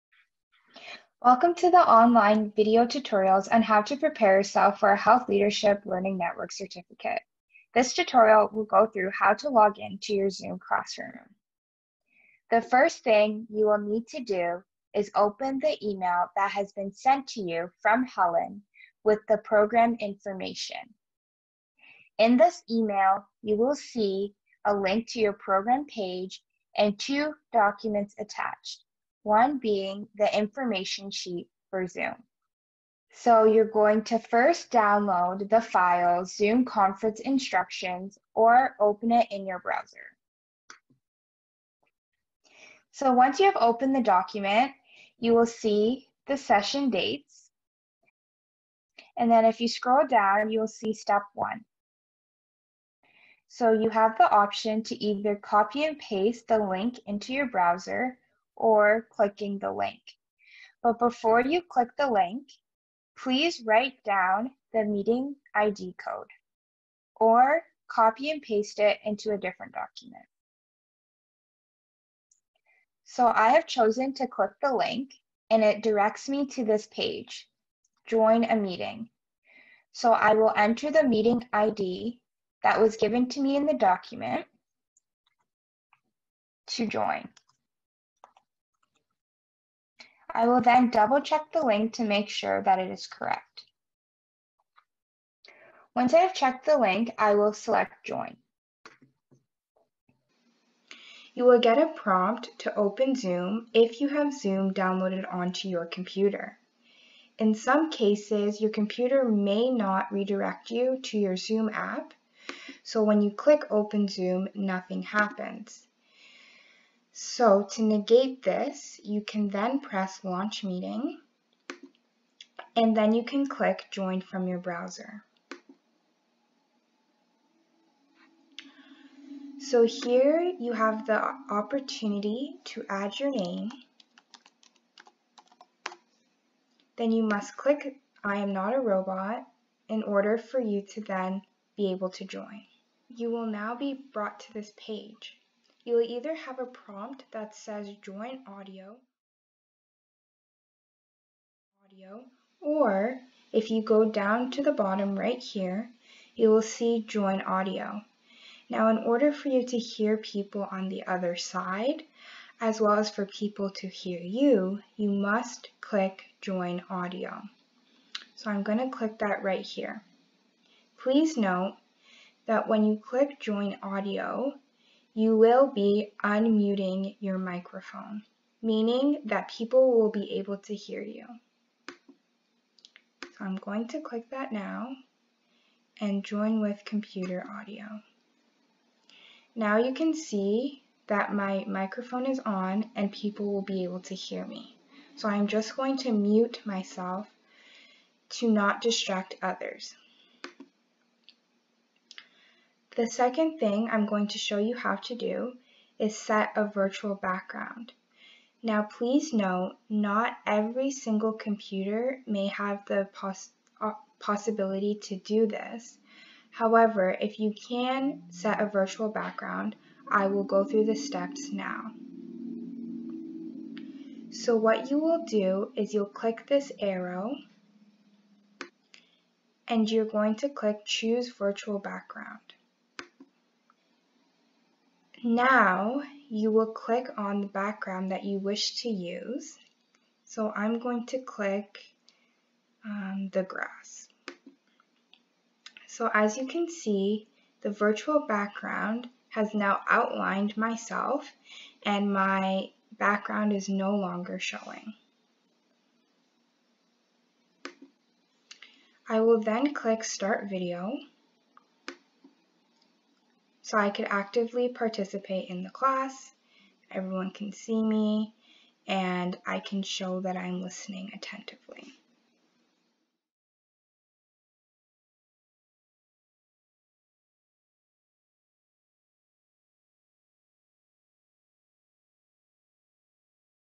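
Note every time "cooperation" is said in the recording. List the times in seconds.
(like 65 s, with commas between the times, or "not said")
not said.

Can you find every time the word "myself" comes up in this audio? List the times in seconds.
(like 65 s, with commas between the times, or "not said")
196 s, 250 s.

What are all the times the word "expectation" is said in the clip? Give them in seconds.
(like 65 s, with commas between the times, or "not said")
not said.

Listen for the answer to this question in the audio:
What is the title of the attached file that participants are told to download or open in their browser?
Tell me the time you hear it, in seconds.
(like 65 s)
36 s.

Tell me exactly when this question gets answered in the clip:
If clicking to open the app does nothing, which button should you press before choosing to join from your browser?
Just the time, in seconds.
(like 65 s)
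120 s.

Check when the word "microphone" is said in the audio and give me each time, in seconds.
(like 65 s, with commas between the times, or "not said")
177 s, 191 s.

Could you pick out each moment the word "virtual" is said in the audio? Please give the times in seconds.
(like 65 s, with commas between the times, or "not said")
206 s, 218 s, 231 s, 247 s.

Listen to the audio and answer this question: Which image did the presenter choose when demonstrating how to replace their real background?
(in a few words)
the grass.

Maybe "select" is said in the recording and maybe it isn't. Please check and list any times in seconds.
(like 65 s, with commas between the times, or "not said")
97 s.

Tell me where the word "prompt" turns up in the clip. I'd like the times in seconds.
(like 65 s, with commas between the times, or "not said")
101 s, 146 s.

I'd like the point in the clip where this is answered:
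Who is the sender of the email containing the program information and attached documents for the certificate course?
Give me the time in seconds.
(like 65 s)
18 s.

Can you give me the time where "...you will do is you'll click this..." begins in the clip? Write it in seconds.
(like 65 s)
224 s.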